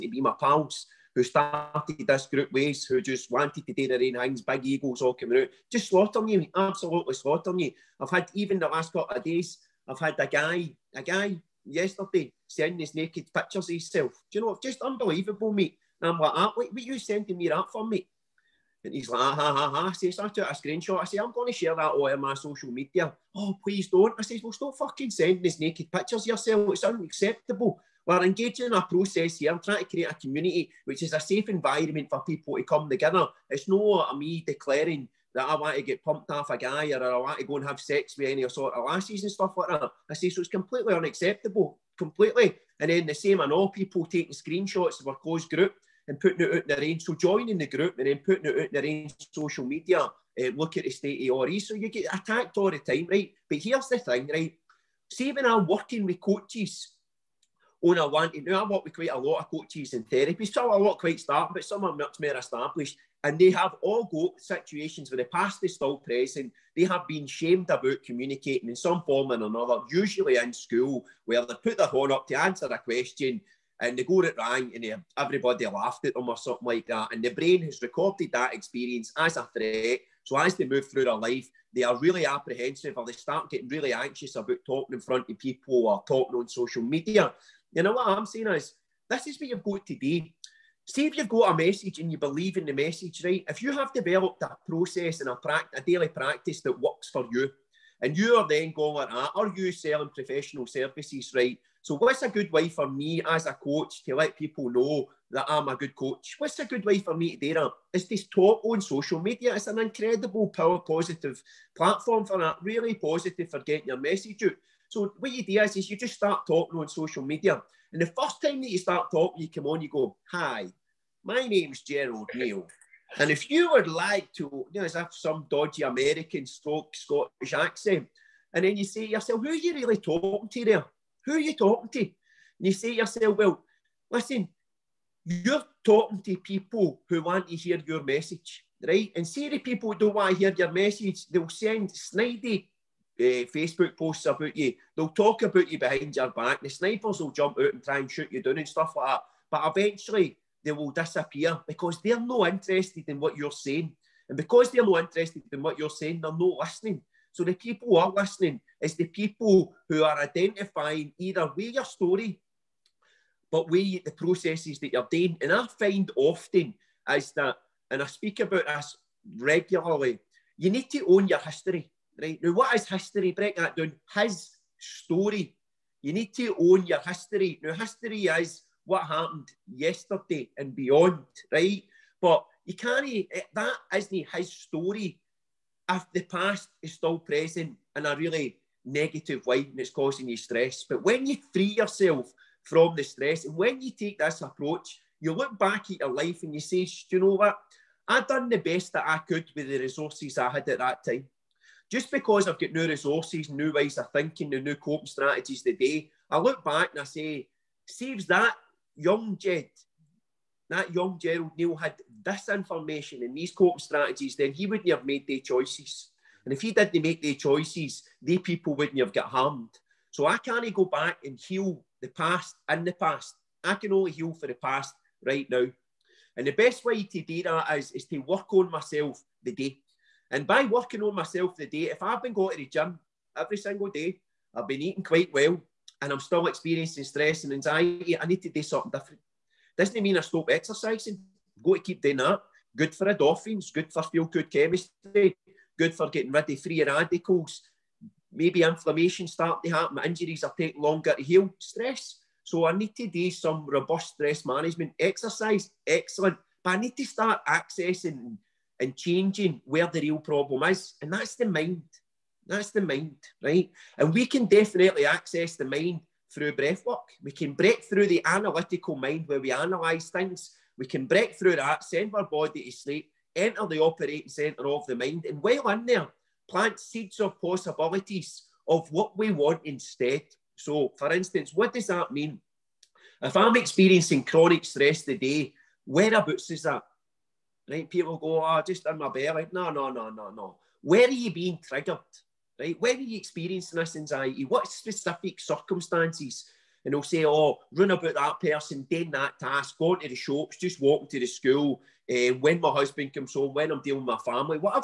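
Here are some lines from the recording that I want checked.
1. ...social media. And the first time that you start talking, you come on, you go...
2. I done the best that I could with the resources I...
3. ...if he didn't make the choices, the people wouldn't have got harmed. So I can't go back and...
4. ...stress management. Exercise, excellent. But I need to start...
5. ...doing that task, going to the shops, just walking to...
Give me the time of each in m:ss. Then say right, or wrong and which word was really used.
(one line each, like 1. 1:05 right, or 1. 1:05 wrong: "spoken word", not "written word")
1. 1:56 right
2. 3:18 right
3. 3:36 right
4. 4:14 right
5. 4:58 right.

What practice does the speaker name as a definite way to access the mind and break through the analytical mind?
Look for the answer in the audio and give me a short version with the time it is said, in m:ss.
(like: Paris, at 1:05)
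breath work, at 4:26.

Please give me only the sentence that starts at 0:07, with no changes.
I've had, even the last couple of days, I've had a guy, a guy yesterday sending his naked pictures of himself.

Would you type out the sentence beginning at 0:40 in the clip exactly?
I say, so it's completely unacceptable, completely.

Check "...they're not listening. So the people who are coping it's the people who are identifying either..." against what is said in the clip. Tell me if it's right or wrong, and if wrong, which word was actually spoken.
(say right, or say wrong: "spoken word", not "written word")
wrong: "listening", not "coping".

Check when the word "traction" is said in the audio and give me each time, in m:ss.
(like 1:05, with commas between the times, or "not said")
not said.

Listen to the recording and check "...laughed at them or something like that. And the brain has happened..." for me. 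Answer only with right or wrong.
wrong.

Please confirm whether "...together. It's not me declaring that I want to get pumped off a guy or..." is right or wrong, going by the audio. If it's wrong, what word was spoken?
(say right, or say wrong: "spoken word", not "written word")
right.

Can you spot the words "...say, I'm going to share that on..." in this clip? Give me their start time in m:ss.
0:21.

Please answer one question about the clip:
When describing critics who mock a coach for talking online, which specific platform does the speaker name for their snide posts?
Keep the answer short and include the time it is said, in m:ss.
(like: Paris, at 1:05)
Facebook, at 2:23.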